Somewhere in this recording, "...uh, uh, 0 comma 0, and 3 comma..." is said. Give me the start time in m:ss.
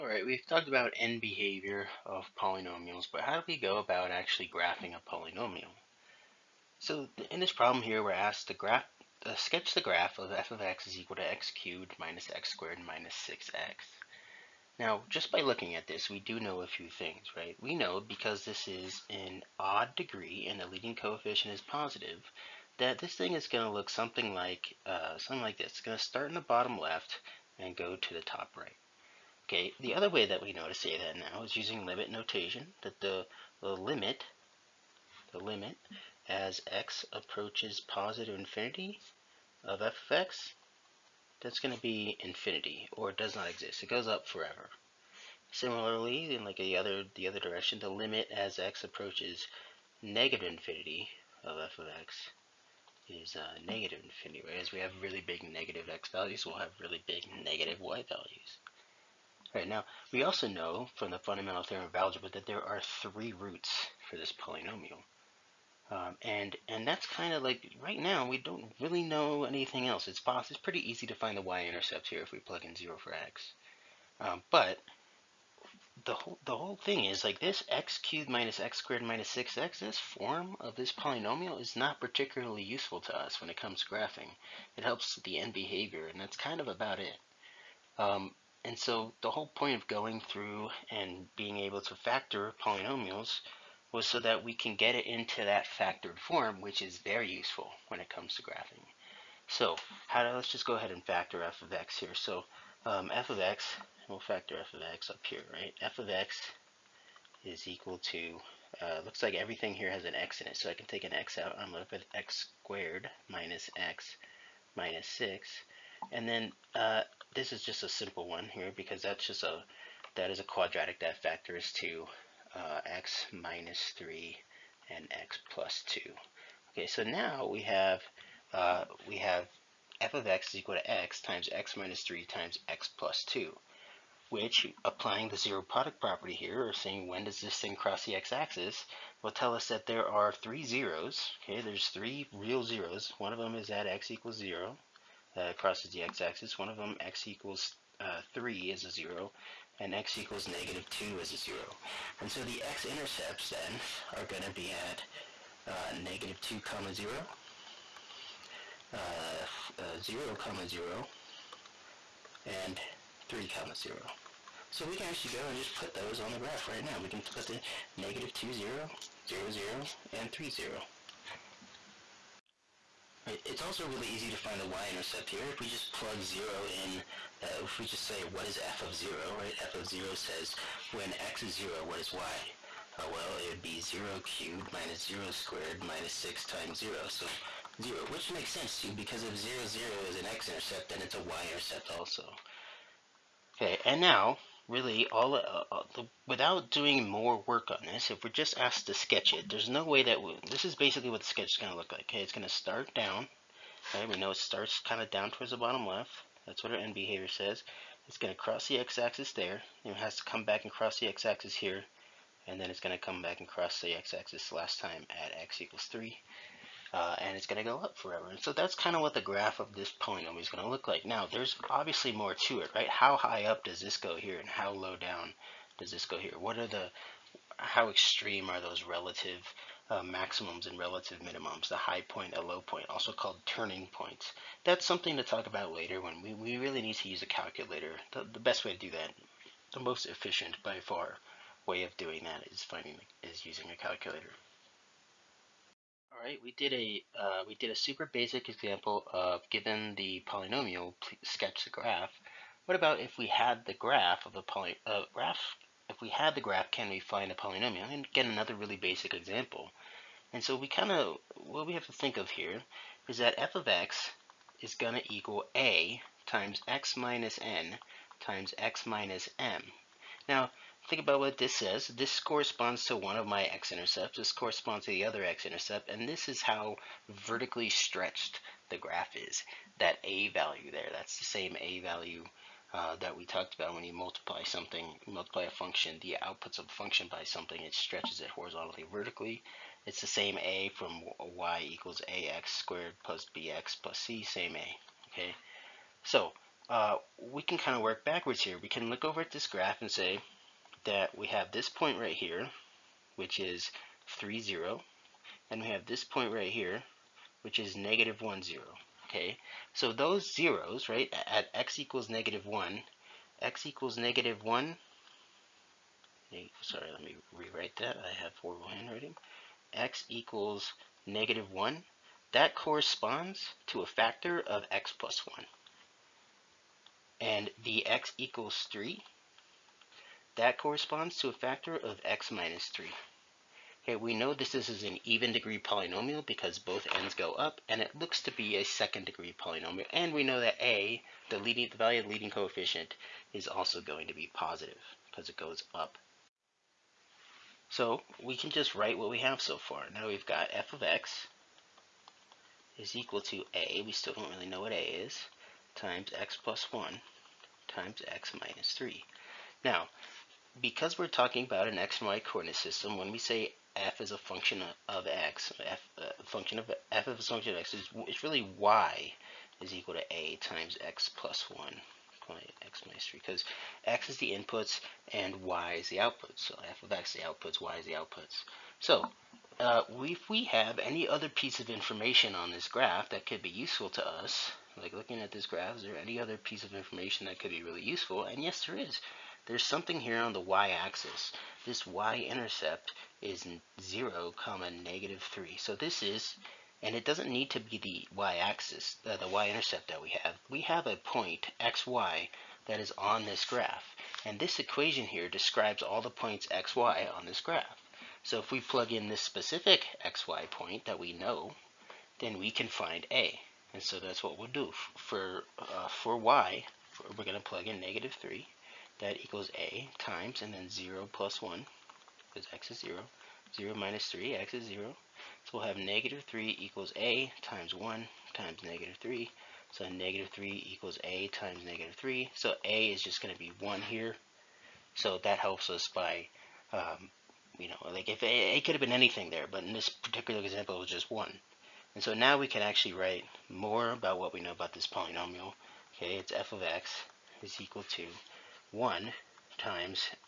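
2:38.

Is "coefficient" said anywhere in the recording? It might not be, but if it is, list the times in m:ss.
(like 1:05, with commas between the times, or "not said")
0:20, 5:42.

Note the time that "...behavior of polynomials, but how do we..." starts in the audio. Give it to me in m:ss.
0:01.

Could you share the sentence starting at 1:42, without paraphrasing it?
So um, f of x, we'll factor f of x up here, right?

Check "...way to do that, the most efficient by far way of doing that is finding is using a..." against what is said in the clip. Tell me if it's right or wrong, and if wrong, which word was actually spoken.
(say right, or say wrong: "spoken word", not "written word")
right.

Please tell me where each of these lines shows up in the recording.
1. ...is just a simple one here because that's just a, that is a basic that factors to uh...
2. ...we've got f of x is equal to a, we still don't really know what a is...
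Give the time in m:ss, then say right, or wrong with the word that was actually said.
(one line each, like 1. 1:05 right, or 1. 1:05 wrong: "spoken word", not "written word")
1. 1:57 wrong: "quadratic", not "basic"
2. 5:50 right.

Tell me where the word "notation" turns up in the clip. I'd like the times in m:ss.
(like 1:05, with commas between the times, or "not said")
0:32.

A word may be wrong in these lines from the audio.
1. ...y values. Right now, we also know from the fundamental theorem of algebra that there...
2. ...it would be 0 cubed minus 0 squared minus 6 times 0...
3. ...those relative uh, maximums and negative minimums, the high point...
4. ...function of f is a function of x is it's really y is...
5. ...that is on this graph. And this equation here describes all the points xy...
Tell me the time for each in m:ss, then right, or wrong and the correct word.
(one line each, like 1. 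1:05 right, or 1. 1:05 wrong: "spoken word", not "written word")
1. 0:57 right
2. 3:03 right
3. 3:48 wrong: "relative", not "negative"
4. 6:06 right
5. 6:42 right.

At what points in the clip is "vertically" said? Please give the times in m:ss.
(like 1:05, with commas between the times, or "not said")
4:37, 4:48.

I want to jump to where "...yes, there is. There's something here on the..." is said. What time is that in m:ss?
6:28.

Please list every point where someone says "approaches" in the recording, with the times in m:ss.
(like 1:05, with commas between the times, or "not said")
0:37, 0:48.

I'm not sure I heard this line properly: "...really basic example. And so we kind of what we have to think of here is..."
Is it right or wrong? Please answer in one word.
right.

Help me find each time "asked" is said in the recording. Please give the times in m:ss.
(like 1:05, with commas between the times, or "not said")
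0:08, 3:18.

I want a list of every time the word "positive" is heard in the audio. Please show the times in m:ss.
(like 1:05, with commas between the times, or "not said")
0:21, 0:37, 5:44.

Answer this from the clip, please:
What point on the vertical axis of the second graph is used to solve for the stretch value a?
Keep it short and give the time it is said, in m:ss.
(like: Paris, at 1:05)
(0, -3), at 6:33.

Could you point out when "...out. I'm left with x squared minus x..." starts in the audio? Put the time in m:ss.
1:51.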